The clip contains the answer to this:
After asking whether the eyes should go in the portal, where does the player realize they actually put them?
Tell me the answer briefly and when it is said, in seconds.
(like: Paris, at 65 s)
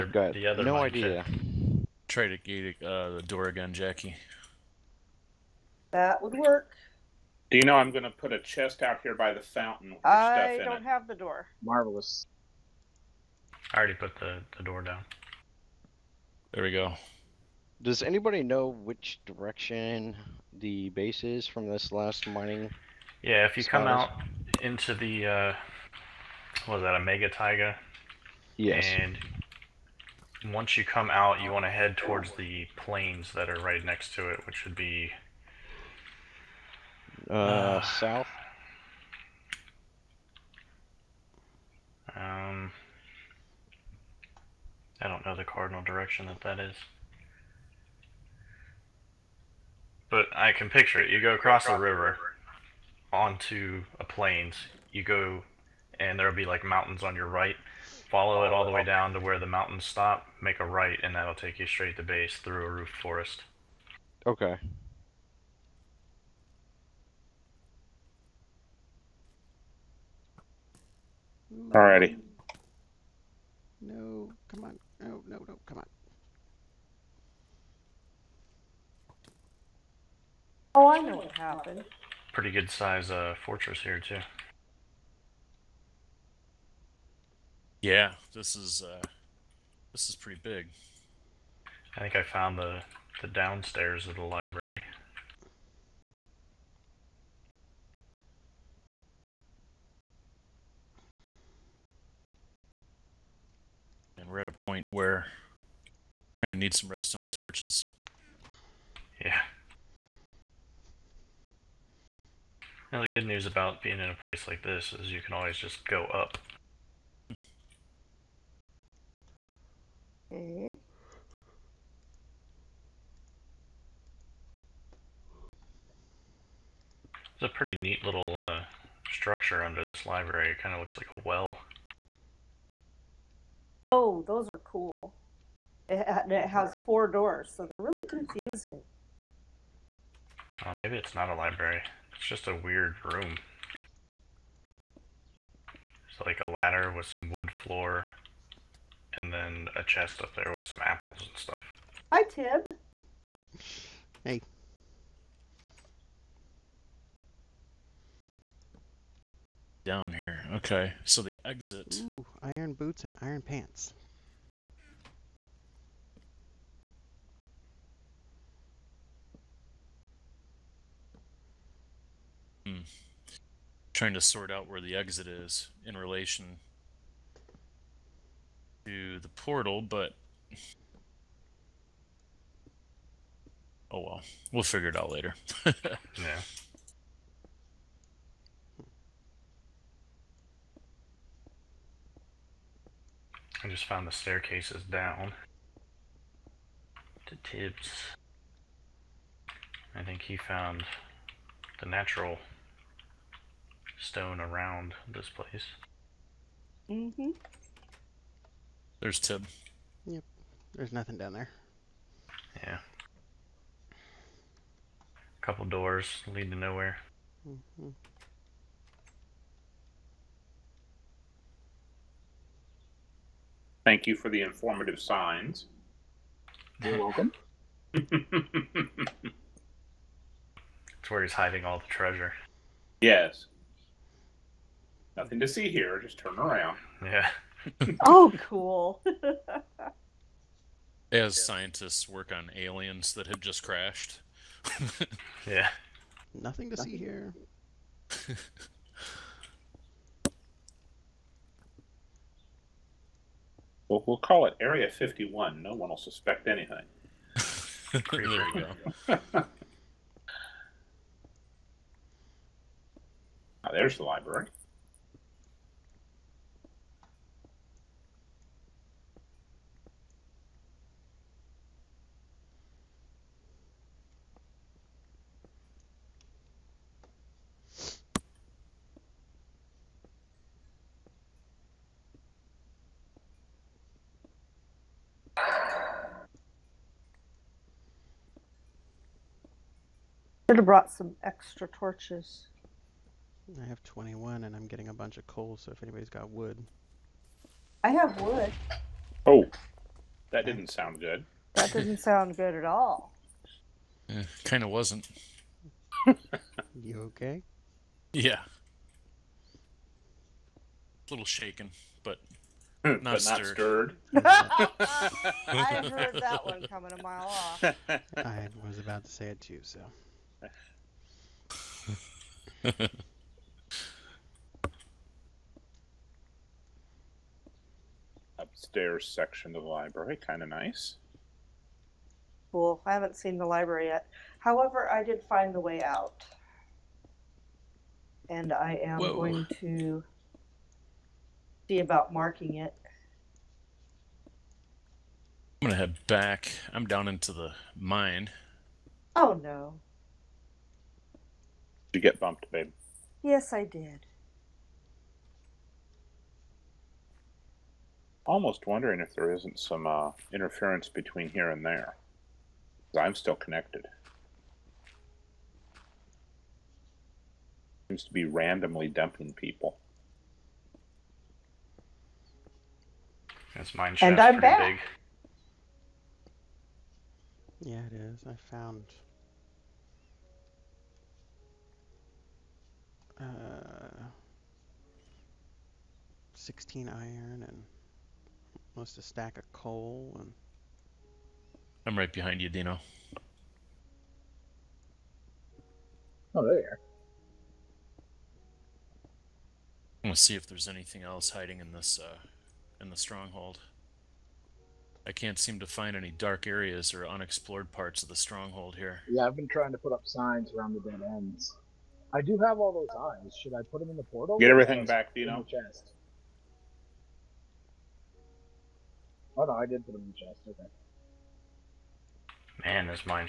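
In the chest, at 420 s.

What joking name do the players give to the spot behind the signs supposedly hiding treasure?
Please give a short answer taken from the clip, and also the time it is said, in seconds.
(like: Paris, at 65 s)
Area 51, at 254 s.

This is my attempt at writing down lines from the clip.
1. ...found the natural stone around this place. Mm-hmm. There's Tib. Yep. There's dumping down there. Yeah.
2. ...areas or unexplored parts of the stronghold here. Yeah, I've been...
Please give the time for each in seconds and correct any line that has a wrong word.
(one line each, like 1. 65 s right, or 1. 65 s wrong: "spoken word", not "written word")
1. 200 s wrong: "nothing", not "dumping"
2. 406 s right.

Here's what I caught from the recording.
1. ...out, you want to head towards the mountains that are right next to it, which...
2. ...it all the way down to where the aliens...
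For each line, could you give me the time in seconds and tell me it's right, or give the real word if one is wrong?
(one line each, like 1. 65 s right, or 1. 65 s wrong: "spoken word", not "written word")
1. 31 s wrong: "plains", not "mountains"
2. 58 s wrong: "mountains", not "aliens".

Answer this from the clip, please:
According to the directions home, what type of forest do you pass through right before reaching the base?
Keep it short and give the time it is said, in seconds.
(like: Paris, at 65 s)
Roofed forest, at 62 s.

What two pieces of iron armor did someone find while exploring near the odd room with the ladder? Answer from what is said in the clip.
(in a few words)
Iron boots and iron pants.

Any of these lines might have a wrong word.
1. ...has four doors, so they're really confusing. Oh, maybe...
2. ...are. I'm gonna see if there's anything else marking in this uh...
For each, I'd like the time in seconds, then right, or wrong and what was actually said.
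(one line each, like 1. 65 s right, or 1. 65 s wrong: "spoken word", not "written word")
1. 136 s right
2. 396 s wrong: "hiding", not "marking".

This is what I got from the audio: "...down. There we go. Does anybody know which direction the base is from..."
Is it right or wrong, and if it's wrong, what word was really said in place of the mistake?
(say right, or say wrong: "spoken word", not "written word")
right.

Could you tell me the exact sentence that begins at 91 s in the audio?
I think I found the the downstairs of the library.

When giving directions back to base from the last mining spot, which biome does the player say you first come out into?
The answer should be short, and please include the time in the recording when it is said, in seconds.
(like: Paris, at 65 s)
Mega Taiga, at 27 s.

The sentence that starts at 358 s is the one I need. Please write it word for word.
Almost wondering if there isn't some uh, interference between here and there.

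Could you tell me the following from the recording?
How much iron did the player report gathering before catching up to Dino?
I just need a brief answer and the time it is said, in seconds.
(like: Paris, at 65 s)
16, at 386 s.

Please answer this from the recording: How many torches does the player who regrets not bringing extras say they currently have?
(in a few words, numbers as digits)
21.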